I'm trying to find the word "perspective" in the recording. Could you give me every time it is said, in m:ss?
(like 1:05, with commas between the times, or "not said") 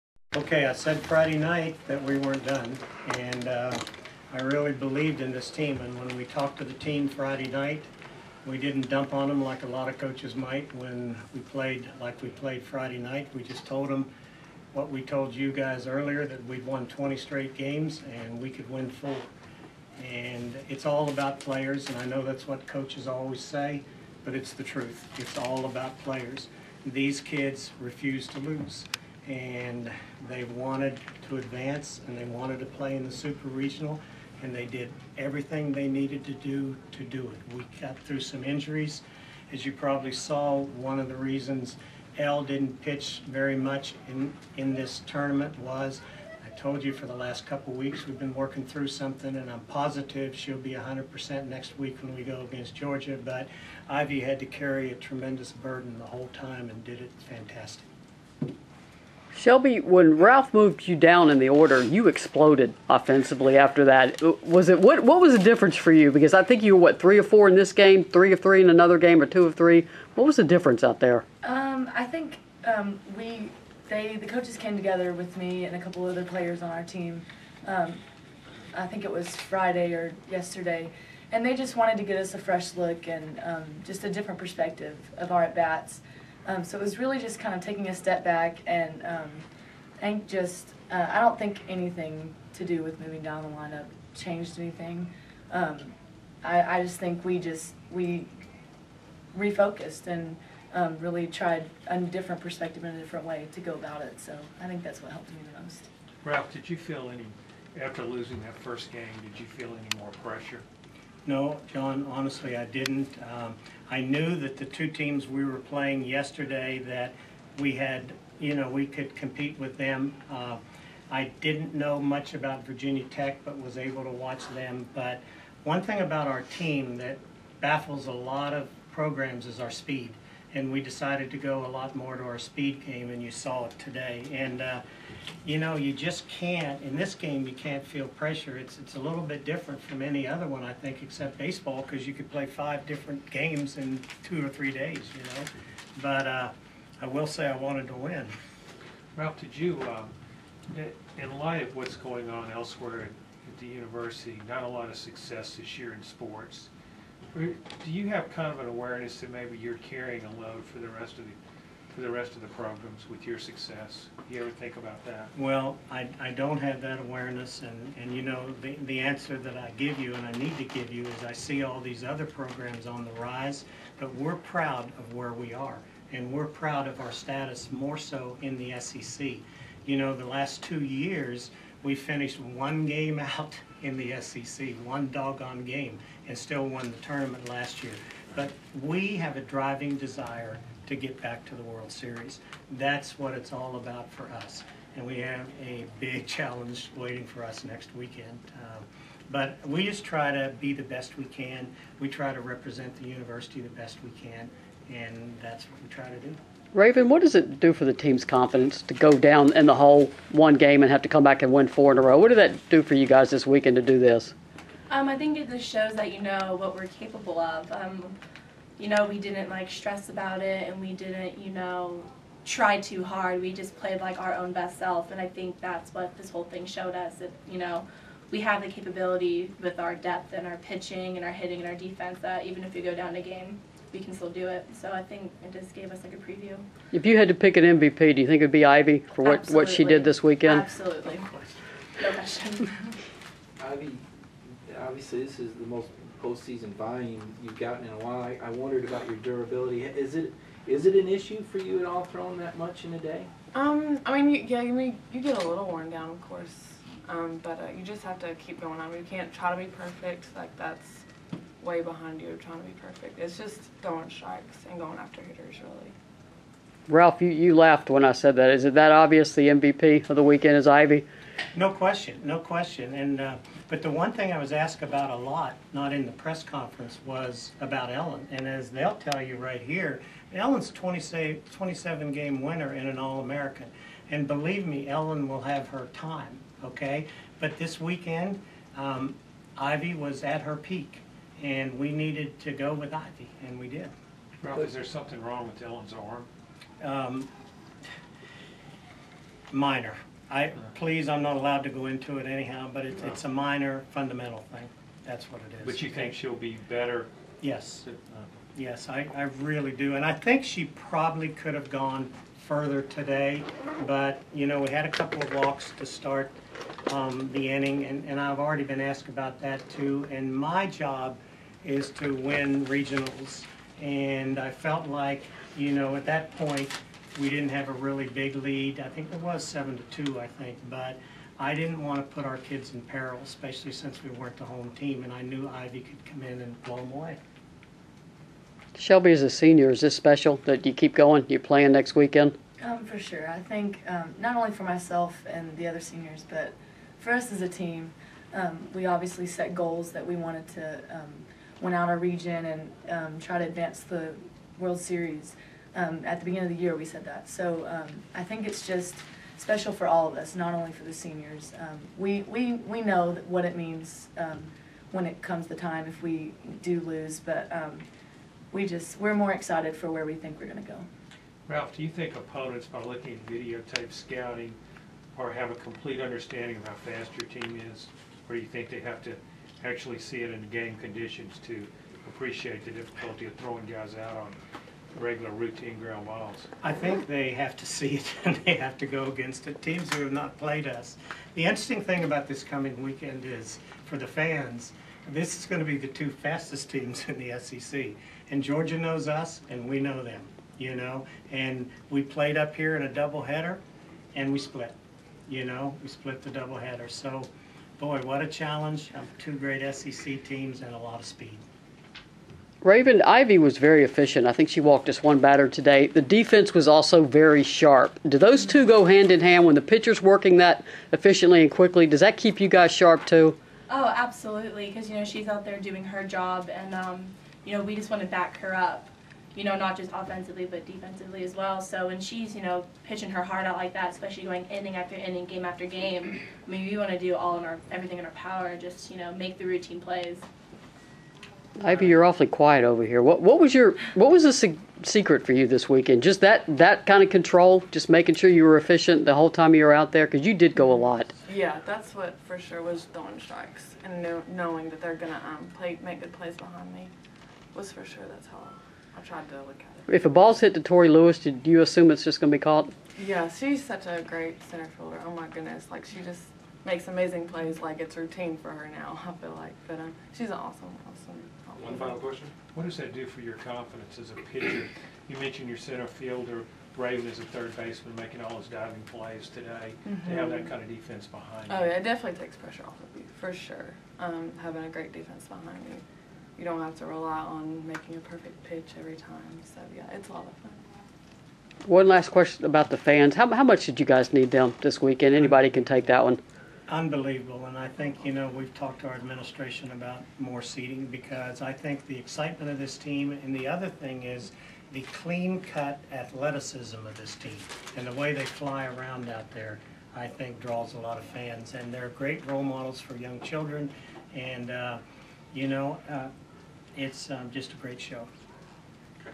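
1:24, 1:42.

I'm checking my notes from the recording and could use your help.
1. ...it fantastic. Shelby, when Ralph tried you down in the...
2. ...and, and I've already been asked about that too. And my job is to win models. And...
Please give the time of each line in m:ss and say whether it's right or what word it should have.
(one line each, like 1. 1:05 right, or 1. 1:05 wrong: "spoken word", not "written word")
1. 0:57 wrong: "moved", not "tried"
2. 5:17 wrong: "regionals", not "models".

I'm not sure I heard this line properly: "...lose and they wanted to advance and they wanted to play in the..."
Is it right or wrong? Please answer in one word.
right.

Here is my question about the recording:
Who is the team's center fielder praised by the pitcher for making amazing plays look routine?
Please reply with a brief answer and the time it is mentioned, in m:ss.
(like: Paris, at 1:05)
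Tori Lewis, at 7:40.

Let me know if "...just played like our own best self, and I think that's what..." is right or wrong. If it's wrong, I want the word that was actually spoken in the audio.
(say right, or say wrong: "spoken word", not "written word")
right.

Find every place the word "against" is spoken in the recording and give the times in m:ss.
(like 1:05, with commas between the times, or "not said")
0:52, 6:29.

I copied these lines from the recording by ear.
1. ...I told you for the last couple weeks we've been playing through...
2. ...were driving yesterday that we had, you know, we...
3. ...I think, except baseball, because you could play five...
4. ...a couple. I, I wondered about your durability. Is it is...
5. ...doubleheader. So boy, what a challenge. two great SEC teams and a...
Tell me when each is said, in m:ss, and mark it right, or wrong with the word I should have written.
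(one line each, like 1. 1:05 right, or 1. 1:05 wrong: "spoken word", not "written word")
1. 0:46 wrong: "working", not "playing"
2. 1:55 wrong: "playing", not "driving"
3. 2:20 right
4. 4:07 wrong: "while", not "couple"
5. 6:46 right.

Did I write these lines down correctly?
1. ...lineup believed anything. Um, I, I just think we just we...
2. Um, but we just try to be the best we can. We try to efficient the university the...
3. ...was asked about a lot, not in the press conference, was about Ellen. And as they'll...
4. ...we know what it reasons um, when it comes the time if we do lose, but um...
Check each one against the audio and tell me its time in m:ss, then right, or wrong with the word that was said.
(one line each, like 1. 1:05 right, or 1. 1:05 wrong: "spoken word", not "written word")
1. 1:33 wrong: "changed", not "believed"
2. 3:18 wrong: "represent", not "efficient"
3. 4:34 right
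4. 6:02 wrong: "means", not "reasons".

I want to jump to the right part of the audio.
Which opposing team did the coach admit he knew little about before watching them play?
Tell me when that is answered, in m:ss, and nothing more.
2:02.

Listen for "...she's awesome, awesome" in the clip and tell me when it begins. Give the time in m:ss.
7:50.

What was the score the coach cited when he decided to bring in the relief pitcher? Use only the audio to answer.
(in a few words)
7 to 2.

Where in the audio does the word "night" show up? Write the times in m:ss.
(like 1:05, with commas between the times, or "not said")
0:01, 0:07, 0:12.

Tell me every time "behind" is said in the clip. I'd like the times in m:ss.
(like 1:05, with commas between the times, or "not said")
4:21, 7:36, 8:01, 8:05.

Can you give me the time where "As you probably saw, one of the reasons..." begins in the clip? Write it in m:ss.
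0:39.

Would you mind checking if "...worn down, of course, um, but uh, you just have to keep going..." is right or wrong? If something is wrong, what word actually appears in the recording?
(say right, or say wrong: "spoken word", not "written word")
right.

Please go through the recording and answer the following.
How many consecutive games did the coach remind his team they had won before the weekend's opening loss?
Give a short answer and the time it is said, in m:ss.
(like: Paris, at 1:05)
20, at 0:16.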